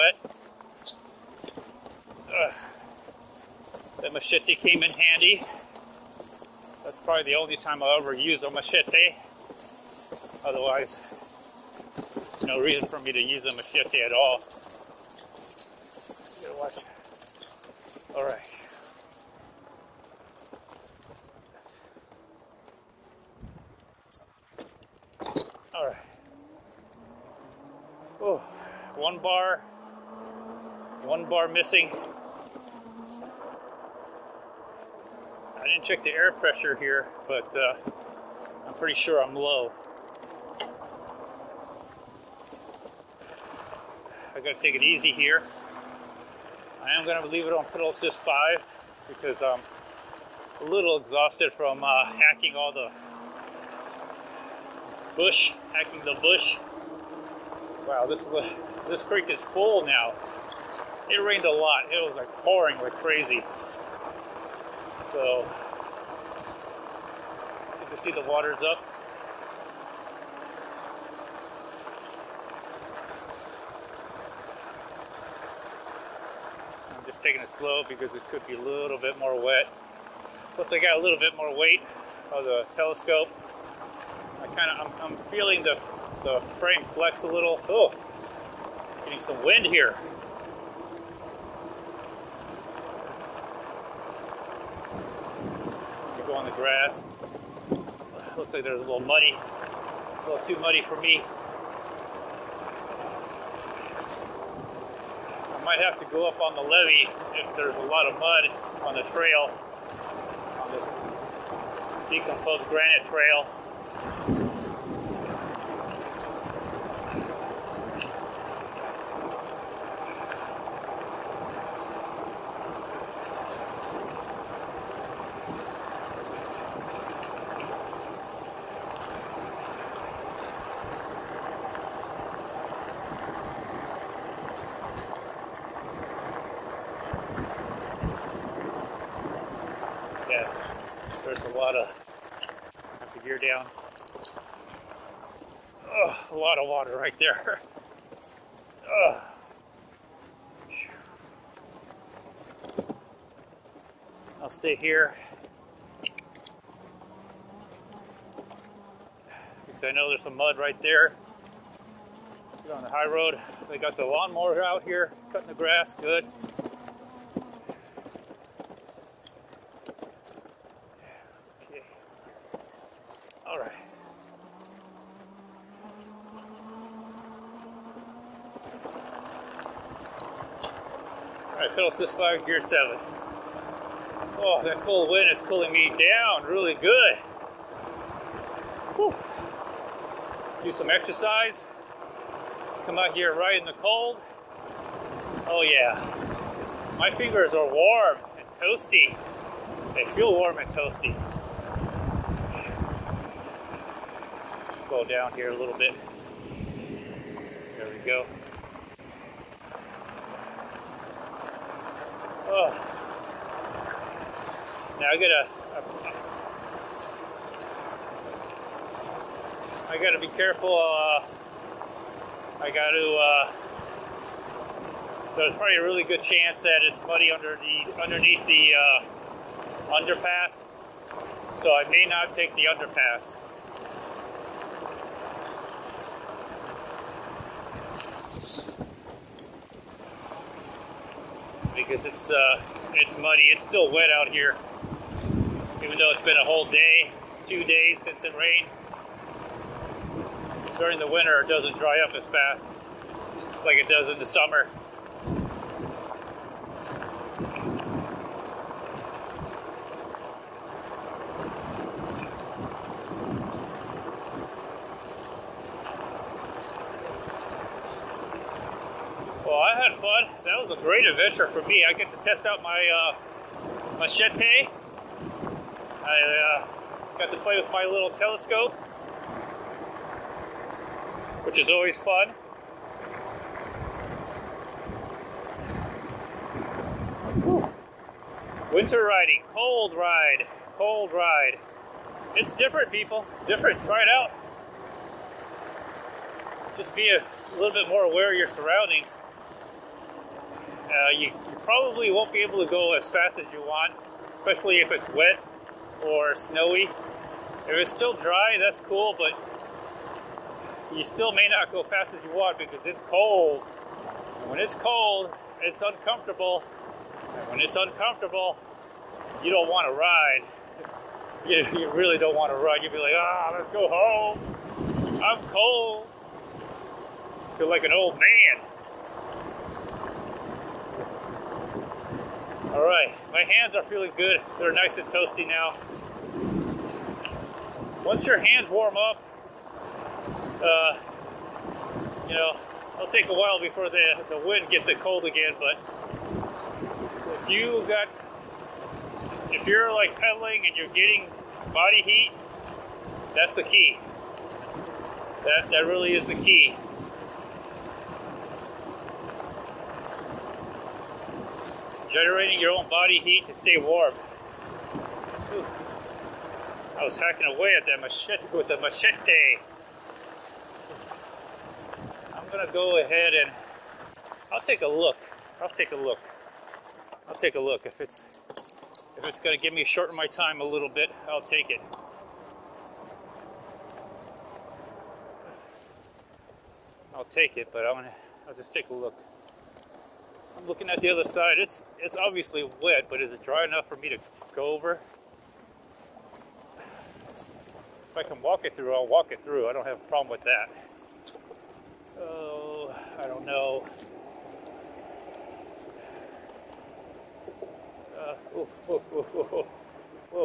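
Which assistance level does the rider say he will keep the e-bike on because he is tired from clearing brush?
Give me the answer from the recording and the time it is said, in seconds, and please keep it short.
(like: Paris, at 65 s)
pedal assist 5, at 47 s.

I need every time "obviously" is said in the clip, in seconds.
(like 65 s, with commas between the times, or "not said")
392 s.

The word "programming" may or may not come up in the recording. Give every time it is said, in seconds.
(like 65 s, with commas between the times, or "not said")
not said.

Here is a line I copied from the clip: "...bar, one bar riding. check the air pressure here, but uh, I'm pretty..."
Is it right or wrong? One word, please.
wrong.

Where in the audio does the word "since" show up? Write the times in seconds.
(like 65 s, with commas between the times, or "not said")
248 s.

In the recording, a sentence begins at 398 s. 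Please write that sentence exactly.
If I can walk it through, I'll walk it through.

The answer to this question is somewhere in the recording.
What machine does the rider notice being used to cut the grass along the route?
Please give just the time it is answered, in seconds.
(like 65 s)
164 s.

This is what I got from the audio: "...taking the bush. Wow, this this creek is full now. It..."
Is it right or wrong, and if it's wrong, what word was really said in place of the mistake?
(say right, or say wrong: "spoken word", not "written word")
wrong: "hacking", not "taking".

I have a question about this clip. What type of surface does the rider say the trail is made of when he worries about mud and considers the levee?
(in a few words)
decomposed granite.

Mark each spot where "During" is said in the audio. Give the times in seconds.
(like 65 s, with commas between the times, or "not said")
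250 s.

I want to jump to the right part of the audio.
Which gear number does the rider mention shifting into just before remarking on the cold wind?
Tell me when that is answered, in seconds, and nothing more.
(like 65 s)
182 s.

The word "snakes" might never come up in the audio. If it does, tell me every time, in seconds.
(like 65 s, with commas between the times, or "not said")
not said.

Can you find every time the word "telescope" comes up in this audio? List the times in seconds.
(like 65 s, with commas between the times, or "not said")
82 s, 278 s.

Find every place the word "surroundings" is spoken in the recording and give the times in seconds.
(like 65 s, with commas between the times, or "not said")
298 s.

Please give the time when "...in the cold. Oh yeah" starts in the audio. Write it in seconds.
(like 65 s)
193 s.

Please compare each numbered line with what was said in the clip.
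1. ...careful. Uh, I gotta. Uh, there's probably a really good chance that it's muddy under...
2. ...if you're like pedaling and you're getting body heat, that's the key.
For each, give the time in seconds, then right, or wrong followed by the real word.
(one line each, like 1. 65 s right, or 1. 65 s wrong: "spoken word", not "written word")
1. 220 s right
2. 349 s right.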